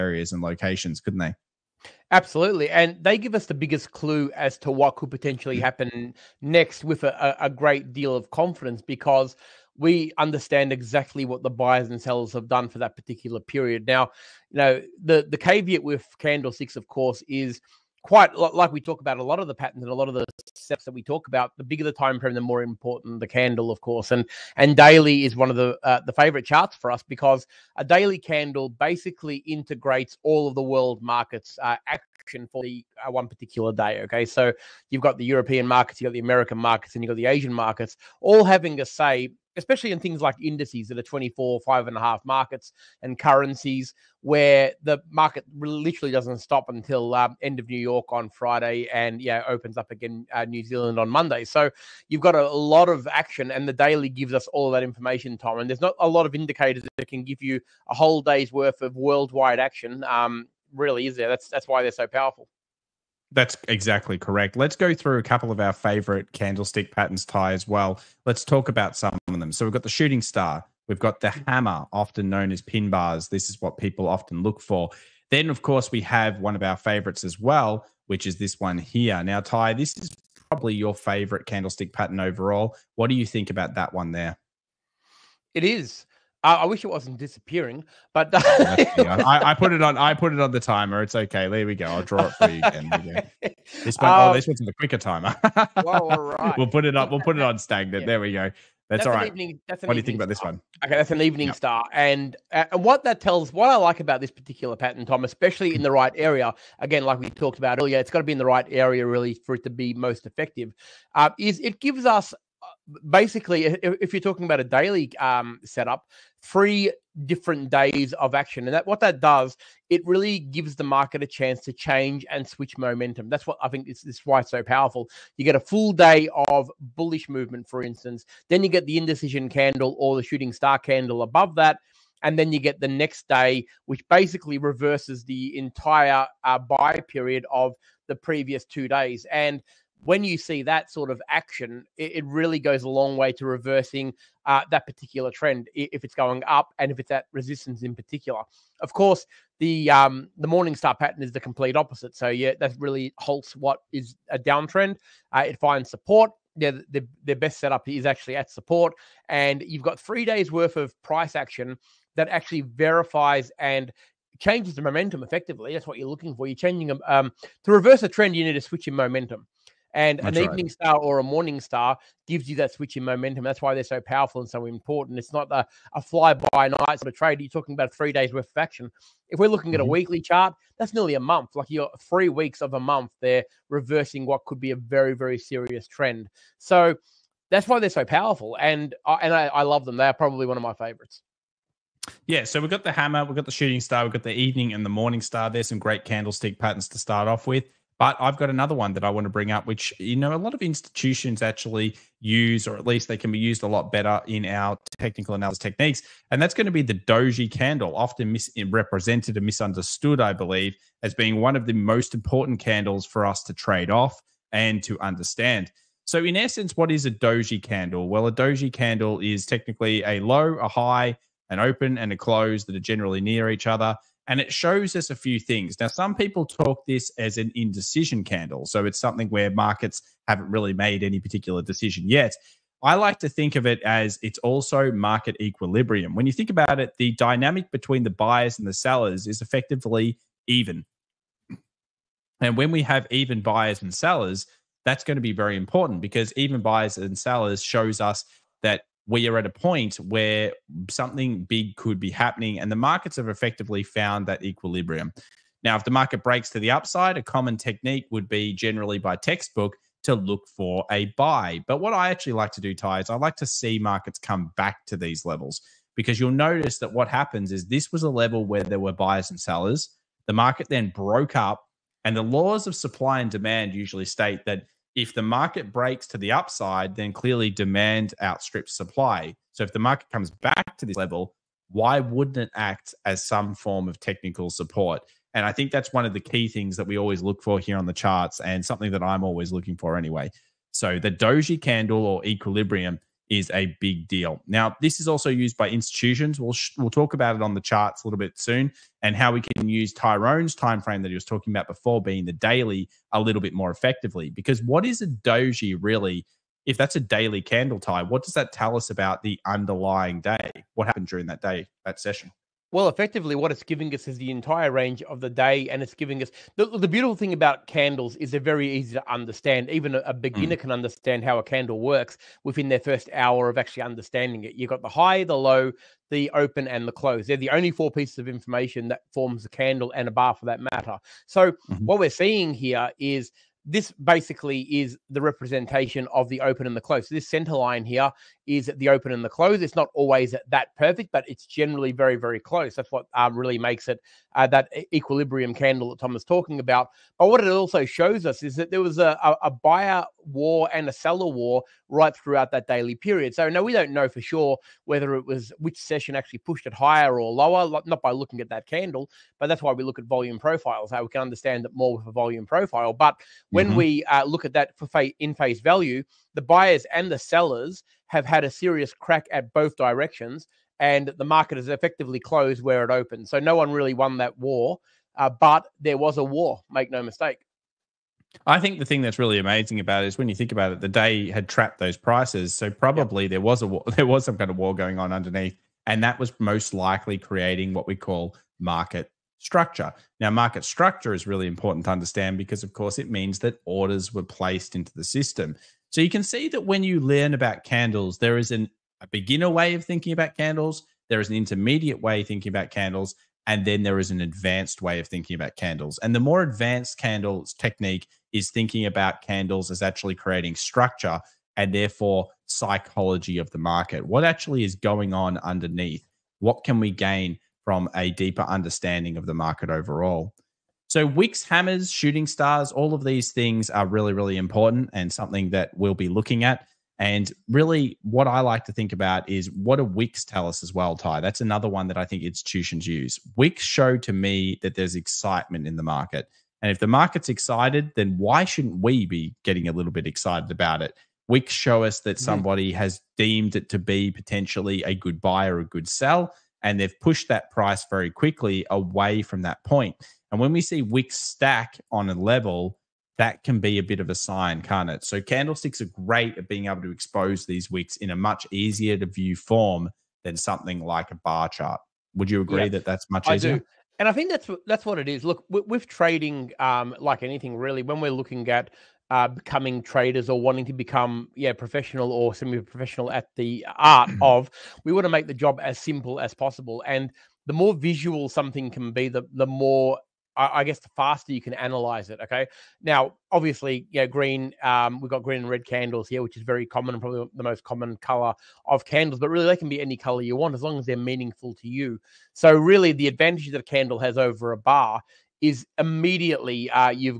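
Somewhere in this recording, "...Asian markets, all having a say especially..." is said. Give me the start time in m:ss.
0:37.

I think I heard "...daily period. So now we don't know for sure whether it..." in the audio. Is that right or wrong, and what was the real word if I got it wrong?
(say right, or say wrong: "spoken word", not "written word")
right.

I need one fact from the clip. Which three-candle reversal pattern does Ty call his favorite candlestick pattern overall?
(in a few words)
Evening star.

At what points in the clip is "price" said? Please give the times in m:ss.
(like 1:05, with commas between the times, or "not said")
2:41, 6:21, 7:27.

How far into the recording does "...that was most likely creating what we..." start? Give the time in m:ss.
6:26.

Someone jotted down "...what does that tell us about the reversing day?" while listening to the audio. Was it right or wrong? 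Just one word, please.
wrong.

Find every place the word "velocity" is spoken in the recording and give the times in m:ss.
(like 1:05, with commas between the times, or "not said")
not said.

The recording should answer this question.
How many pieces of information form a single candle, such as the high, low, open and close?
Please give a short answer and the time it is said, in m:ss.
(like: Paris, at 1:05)
4, at 5:27.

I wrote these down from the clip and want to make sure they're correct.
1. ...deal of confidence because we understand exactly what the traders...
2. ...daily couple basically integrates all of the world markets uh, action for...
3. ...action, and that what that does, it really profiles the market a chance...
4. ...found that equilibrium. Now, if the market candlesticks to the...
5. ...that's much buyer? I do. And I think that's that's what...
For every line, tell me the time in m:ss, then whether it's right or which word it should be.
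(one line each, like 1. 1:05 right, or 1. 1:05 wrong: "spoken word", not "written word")
1. 0:07 wrong: "buyers", not "traders"
2. 0:27 wrong: "candle", not "couple"
3. 1:58 wrong: "gives", not "profiles"
4. 4:13 wrong: "breaks", not "candlesticks"
5. 7:42 wrong: "easier", not "buyer".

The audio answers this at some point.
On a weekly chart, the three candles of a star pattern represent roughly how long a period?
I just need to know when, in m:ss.
3:00.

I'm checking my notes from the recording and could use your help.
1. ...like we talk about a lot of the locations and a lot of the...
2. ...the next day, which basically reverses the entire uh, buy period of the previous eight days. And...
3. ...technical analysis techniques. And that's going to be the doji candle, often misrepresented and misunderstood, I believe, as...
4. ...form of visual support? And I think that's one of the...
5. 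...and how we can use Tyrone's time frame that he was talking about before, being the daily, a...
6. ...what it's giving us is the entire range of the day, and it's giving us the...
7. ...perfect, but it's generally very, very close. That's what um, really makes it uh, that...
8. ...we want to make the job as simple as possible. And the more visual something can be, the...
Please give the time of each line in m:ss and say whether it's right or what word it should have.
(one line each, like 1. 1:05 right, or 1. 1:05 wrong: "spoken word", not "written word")
1. 0:18 wrong: "patterns", not "locations"
2. 2:12 wrong: "two", not "eight"
3. 3:24 right
4. 4:43 wrong: "technical", not "visual"
5. 4:59 right
6. 5:13 right
7. 5:40 right
8. 7:54 right.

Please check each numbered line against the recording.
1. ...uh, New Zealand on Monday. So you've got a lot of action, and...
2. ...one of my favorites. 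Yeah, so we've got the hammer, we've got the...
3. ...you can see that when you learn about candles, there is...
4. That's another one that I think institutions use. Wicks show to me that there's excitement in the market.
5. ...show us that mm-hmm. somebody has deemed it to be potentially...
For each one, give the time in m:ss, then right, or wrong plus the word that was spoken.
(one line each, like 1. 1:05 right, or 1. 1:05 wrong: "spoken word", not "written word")
1. 0:50 right
2. 3:10 right
3. 6:36 right
4. 7:11 right
5. 7:21 right.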